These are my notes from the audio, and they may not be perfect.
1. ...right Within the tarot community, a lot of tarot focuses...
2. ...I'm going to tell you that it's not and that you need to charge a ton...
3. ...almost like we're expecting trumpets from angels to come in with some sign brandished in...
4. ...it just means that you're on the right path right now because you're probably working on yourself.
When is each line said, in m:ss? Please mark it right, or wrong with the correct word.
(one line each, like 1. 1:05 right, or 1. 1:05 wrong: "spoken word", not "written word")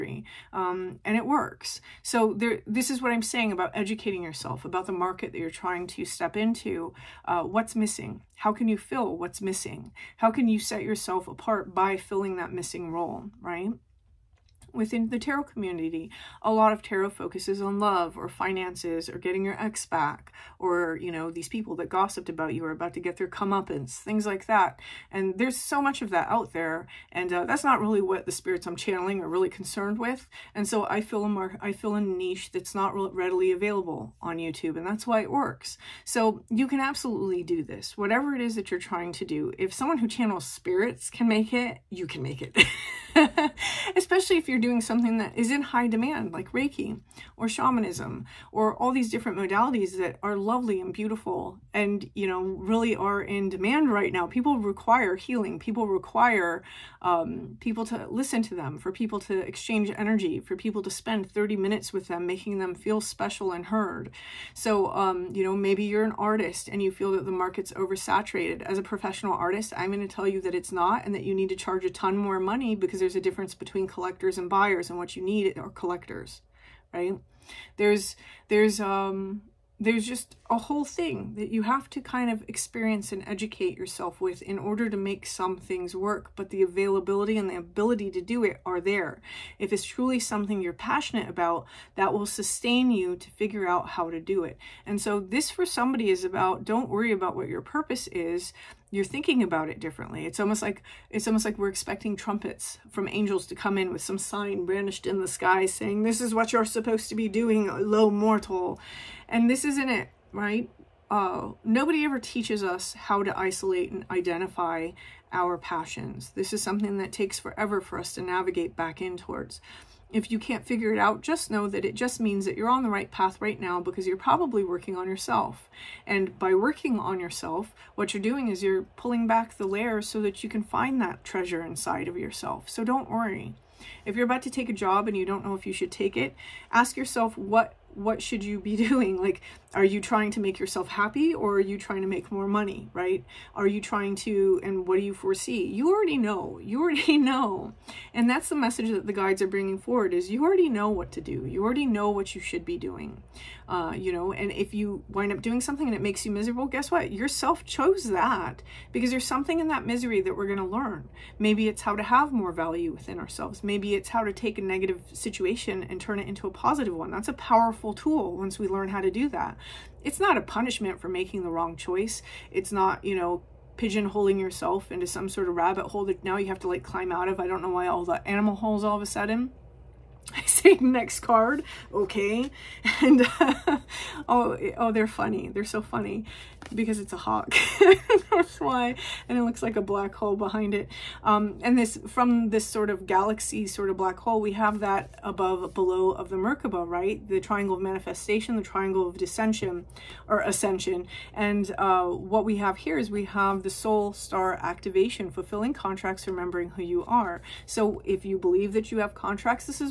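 1. 0:13 right
2. 1:09 right
3. 1:41 right
4. 2:01 right.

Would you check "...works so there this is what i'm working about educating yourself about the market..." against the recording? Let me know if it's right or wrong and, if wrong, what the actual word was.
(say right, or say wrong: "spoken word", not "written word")
wrong: "saying", not "working".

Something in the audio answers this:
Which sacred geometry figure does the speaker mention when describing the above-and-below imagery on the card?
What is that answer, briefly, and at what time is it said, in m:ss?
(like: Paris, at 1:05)
Merkaba, at 3:16.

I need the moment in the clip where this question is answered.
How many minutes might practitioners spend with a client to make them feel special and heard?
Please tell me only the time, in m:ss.
1:01.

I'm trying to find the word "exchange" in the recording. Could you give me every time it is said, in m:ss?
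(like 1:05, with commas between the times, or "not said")
0:59.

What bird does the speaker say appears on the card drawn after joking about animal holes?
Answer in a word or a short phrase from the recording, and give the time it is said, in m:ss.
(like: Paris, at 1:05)
Hawk, at 3:07.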